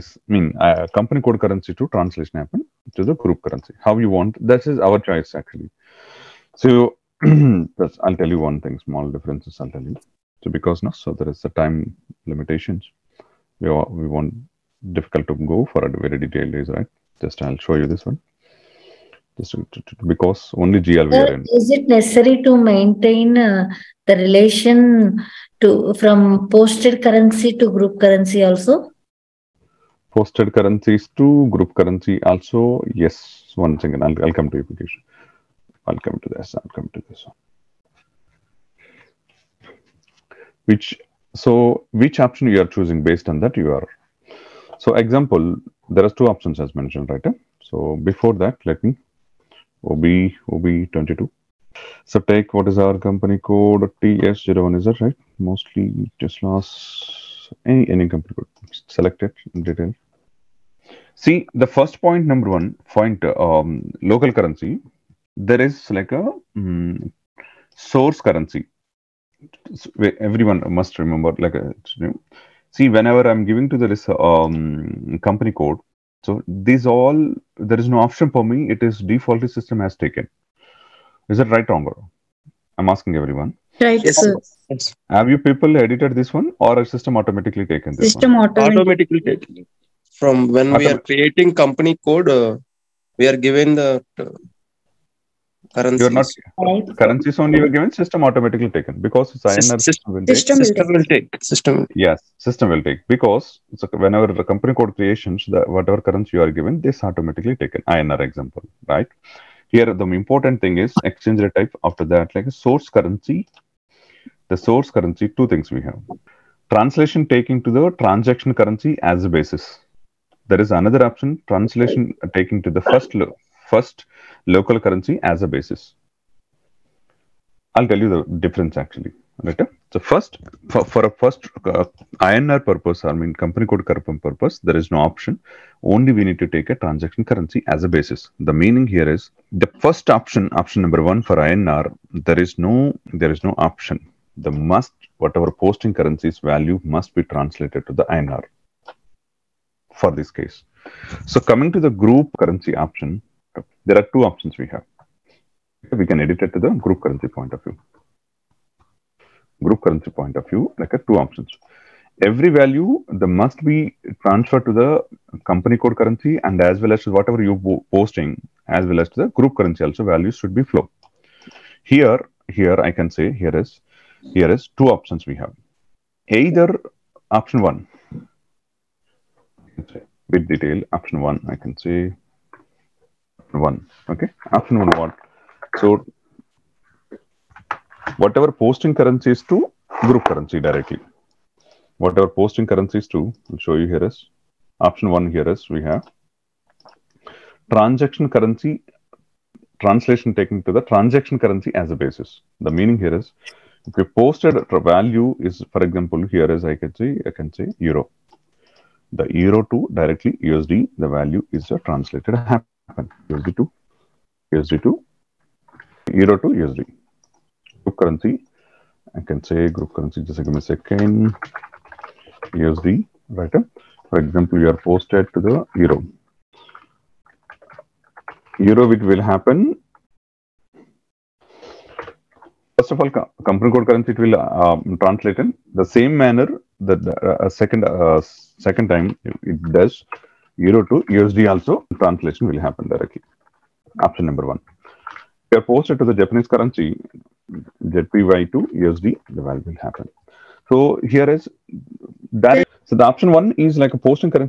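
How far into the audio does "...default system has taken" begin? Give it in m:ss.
1:19.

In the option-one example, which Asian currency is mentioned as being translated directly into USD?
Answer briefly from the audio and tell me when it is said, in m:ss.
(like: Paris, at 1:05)
JPY, at 4:07.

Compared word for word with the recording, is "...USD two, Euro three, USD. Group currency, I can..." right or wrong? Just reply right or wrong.
wrong.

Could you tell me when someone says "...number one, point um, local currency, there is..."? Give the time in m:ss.
1:02.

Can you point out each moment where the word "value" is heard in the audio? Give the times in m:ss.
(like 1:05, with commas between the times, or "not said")
2:26, 2:42, 2:50, 3:24, 3:31, 4:09.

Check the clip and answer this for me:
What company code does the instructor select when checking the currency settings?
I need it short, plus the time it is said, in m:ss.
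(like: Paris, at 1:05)
TS01, at 0:54.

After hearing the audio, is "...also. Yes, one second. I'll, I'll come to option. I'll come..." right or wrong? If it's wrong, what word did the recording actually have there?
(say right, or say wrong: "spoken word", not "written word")
wrong: "application", not "option".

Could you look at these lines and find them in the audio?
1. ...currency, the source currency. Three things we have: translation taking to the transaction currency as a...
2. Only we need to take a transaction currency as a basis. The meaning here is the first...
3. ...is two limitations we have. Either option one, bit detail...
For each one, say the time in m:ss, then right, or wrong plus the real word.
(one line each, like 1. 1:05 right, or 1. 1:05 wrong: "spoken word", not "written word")
1. 1:52 wrong: "Two", not "Three"
2. 2:15 right
3. 2:54 wrong: "options", not "limitations".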